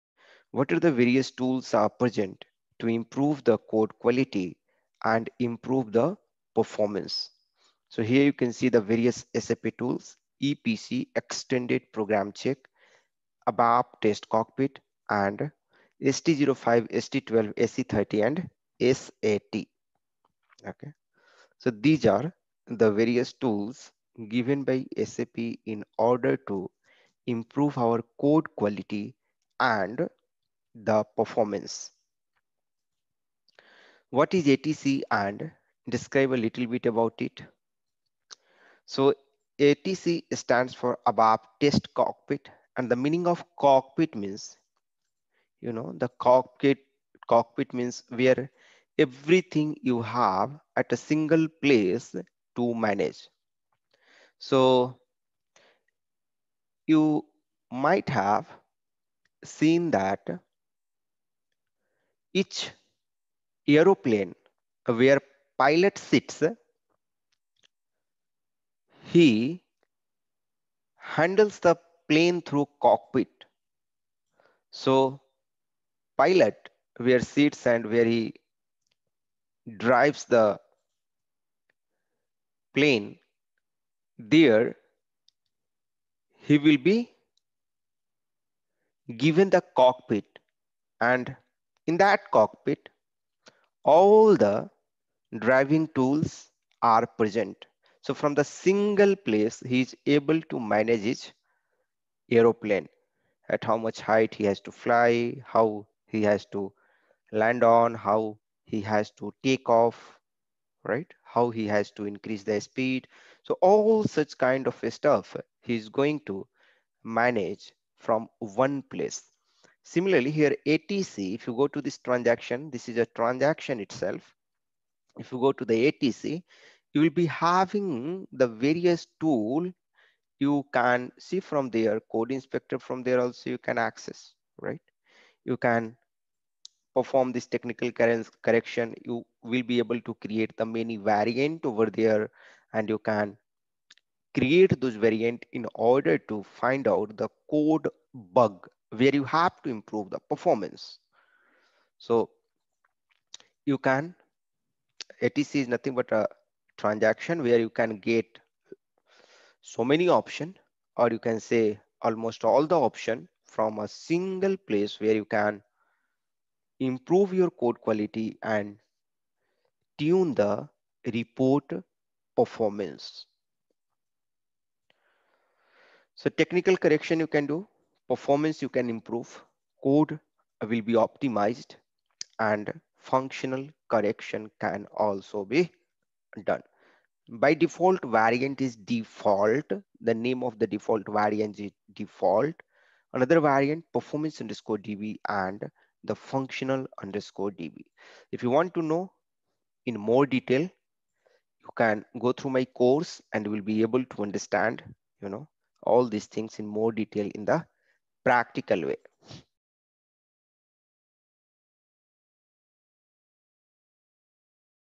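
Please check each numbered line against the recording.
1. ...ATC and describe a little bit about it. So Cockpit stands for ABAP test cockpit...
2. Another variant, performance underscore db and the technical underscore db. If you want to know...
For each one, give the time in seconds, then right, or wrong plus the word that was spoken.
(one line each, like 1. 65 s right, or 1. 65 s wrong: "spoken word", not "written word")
1. 34 s wrong: "ATC", not "Cockpit"
2. 193 s wrong: "functional", not "technical".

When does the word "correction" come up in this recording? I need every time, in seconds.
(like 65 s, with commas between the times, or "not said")
137 s, 176 s, 183 s.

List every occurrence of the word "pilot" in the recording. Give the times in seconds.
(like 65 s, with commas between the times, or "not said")
65 s, 76 s.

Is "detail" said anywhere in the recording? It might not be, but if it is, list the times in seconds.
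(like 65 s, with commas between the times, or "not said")
200 s, 206 s.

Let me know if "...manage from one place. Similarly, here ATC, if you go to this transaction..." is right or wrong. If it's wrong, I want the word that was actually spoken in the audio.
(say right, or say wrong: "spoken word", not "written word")
right.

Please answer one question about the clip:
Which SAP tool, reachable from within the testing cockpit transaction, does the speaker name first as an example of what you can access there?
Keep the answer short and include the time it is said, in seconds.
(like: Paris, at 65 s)
Code Inspector, at 132 s.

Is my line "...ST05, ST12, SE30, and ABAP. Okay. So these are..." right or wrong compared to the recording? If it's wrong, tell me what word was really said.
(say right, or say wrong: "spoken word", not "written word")
wrong: "SAT", not "ABAP".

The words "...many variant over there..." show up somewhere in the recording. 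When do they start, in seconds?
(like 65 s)
140 s.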